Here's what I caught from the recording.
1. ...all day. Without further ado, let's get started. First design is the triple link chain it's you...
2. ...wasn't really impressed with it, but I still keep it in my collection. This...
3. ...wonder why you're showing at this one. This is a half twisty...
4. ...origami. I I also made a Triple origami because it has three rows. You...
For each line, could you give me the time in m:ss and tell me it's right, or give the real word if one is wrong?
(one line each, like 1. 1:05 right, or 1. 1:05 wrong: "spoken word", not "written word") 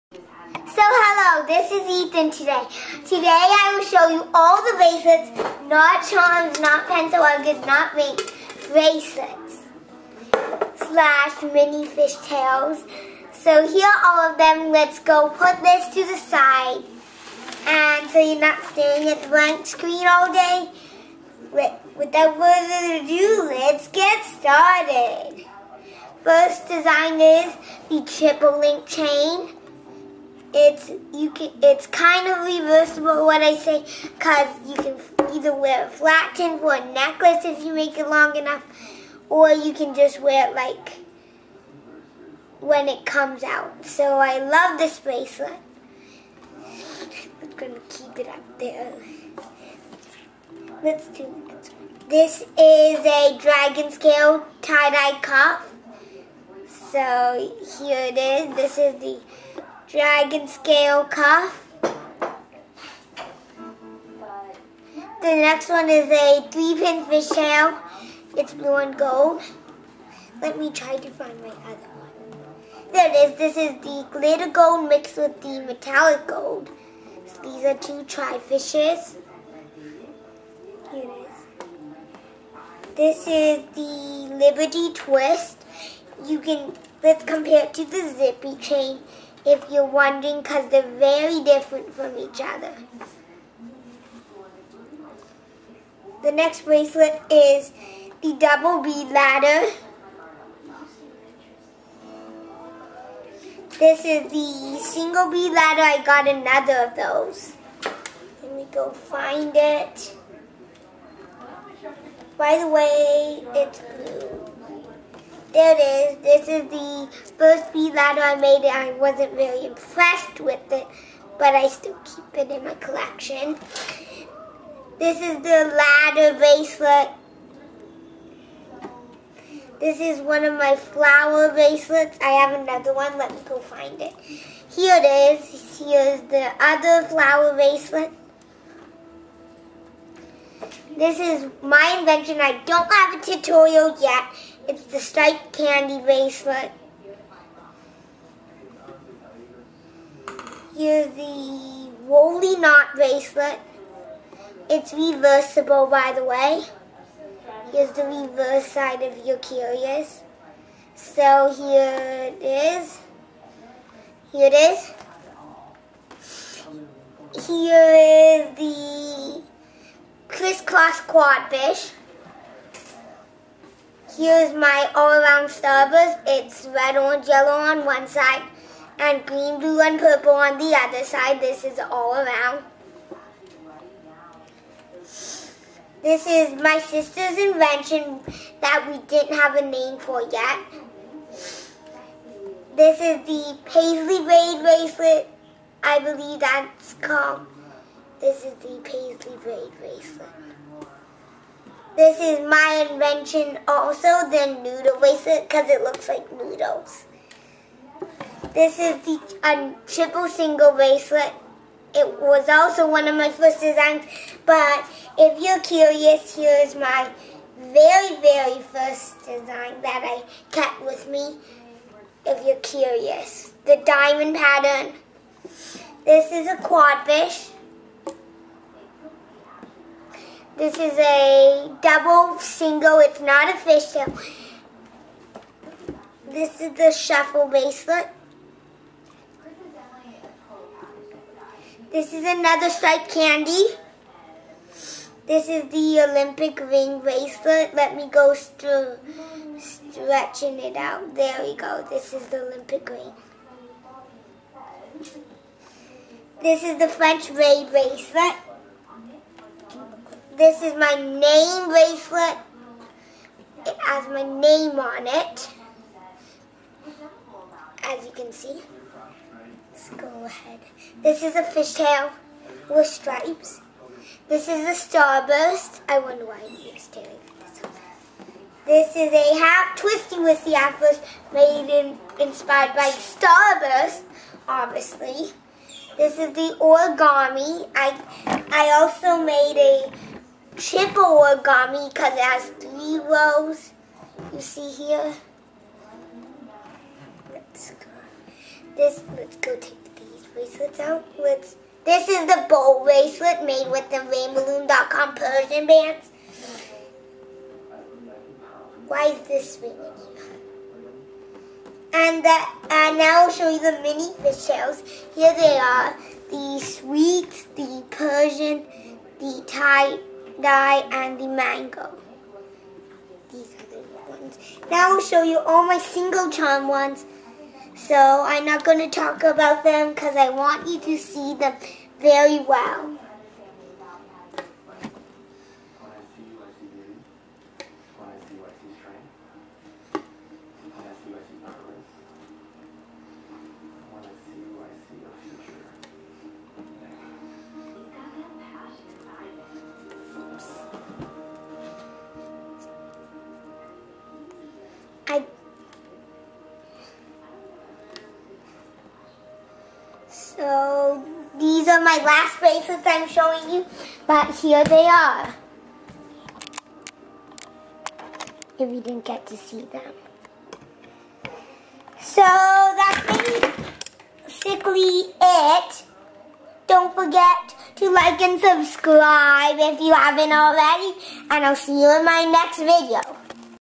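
1. 0:20 right
2. 1:58 right
3. 4:35 wrong: "staring", not "showing"
4. 4:46 right.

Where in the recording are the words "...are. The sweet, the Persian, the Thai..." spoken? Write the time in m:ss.
5:15.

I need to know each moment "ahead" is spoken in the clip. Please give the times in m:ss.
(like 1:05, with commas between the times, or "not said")
4:30.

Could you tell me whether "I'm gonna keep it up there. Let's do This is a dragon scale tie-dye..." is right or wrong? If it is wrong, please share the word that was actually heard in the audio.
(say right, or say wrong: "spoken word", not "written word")
right.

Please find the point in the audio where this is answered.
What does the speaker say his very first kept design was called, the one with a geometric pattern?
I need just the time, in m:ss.
3:43.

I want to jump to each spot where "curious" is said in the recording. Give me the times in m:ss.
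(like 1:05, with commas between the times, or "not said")
2:39, 3:35, 3:42.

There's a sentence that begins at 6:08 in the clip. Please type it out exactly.
If you didn't get to see them.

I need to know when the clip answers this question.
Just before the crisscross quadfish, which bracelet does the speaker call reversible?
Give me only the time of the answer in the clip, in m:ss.
2:32.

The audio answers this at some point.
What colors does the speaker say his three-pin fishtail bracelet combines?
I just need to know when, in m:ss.
1:08.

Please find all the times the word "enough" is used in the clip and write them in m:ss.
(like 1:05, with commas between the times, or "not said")
0:38.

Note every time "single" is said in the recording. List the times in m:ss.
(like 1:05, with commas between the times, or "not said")
1:44, 3:30, 3:52, 5:25.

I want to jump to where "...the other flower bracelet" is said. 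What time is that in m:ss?
2:16.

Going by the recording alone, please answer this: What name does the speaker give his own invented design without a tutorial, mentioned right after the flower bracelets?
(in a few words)
striped candy bracelet.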